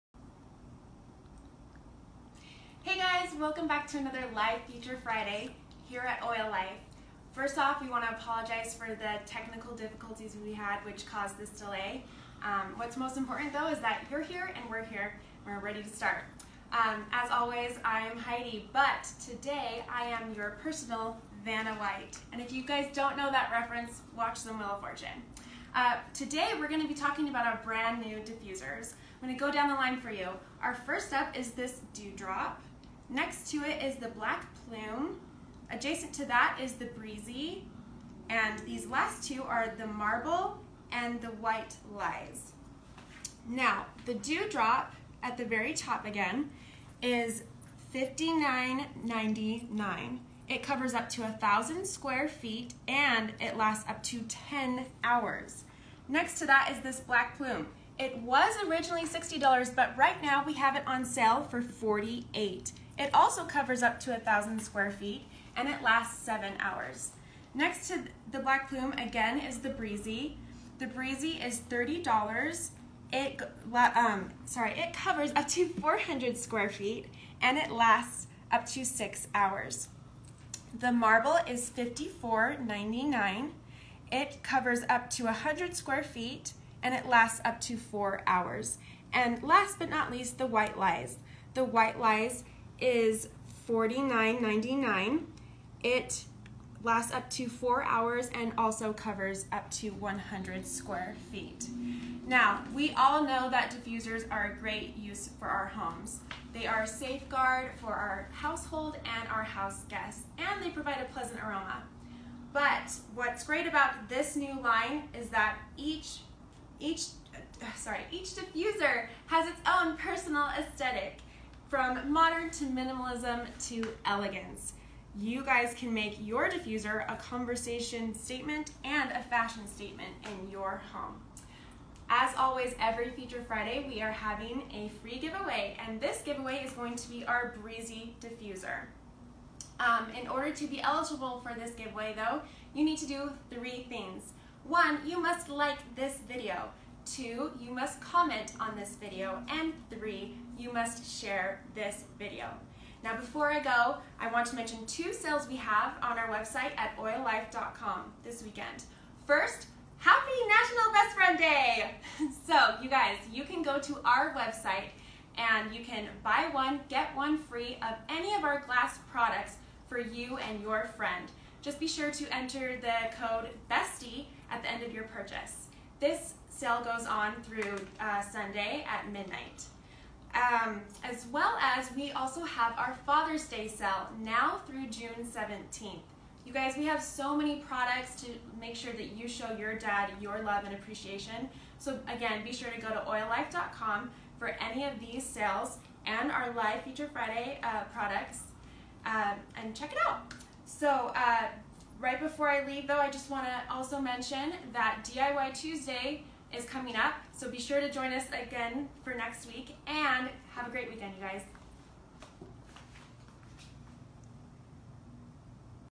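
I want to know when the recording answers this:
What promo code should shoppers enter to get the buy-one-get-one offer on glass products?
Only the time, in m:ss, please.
2:53.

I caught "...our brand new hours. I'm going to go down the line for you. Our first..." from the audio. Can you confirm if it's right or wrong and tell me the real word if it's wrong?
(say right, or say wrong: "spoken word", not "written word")
wrong: "diffusers", not "hours".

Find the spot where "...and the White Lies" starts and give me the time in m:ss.
0:40.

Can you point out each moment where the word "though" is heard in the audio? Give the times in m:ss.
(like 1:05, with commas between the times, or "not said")
0:13, 2:22, 3:22.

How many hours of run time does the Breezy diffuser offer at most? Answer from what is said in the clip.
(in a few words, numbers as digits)
6 hours.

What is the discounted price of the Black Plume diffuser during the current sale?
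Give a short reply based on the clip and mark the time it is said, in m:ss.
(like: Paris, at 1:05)
$48, at 1:01.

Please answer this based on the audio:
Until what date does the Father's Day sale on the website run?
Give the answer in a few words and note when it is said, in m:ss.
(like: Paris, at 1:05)
June 17th, at 3:04.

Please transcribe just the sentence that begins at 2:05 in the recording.
You guys can make your diffuser a conversation statement and a fashion statement in your home.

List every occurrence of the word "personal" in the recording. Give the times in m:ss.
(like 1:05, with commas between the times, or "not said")
0:20, 1:59.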